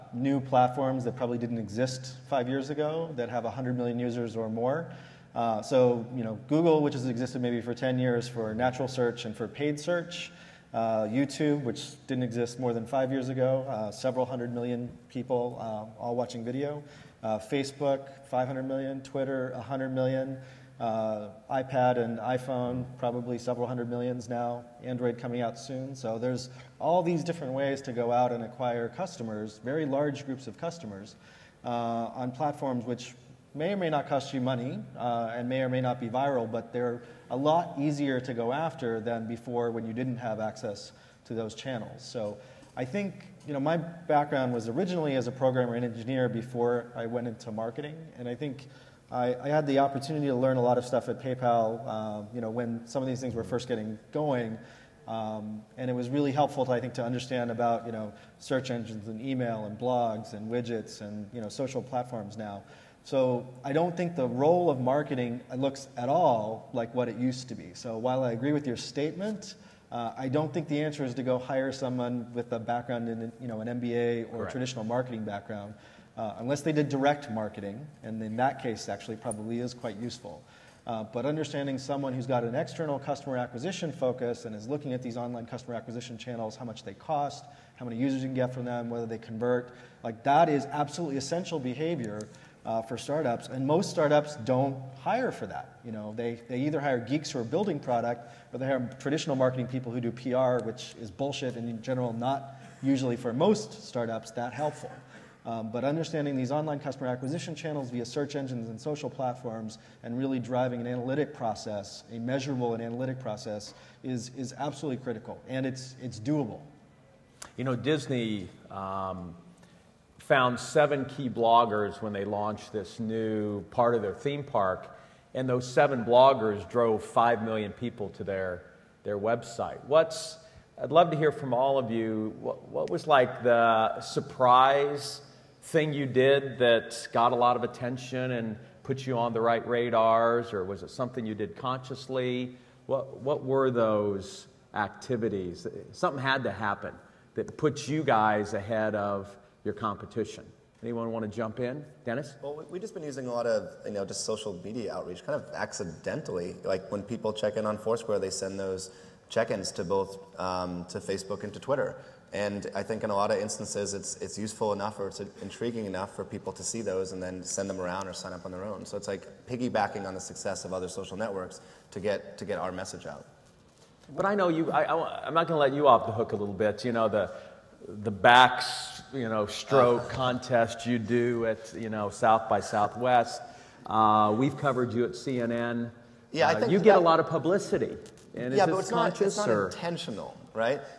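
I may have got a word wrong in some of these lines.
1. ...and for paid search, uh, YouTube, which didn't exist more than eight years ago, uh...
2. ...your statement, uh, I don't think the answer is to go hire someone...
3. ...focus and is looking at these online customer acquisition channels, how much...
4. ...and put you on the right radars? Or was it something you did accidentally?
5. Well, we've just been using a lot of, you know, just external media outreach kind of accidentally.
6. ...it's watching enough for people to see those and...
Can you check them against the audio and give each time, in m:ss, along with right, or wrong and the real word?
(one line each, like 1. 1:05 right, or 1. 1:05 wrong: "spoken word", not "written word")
1. 0:09 wrong: "five", not "eight"
2. 1:08 right
3. 1:23 right
4. 2:18 wrong: "consciously", not "accidentally"
5. 2:32 wrong: "social", not "external"
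6. 2:45 wrong: "intriguing", not "watching".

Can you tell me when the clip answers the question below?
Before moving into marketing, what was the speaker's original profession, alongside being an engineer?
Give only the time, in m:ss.
0:45.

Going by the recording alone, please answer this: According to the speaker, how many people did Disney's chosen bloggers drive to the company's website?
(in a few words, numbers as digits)
5 million.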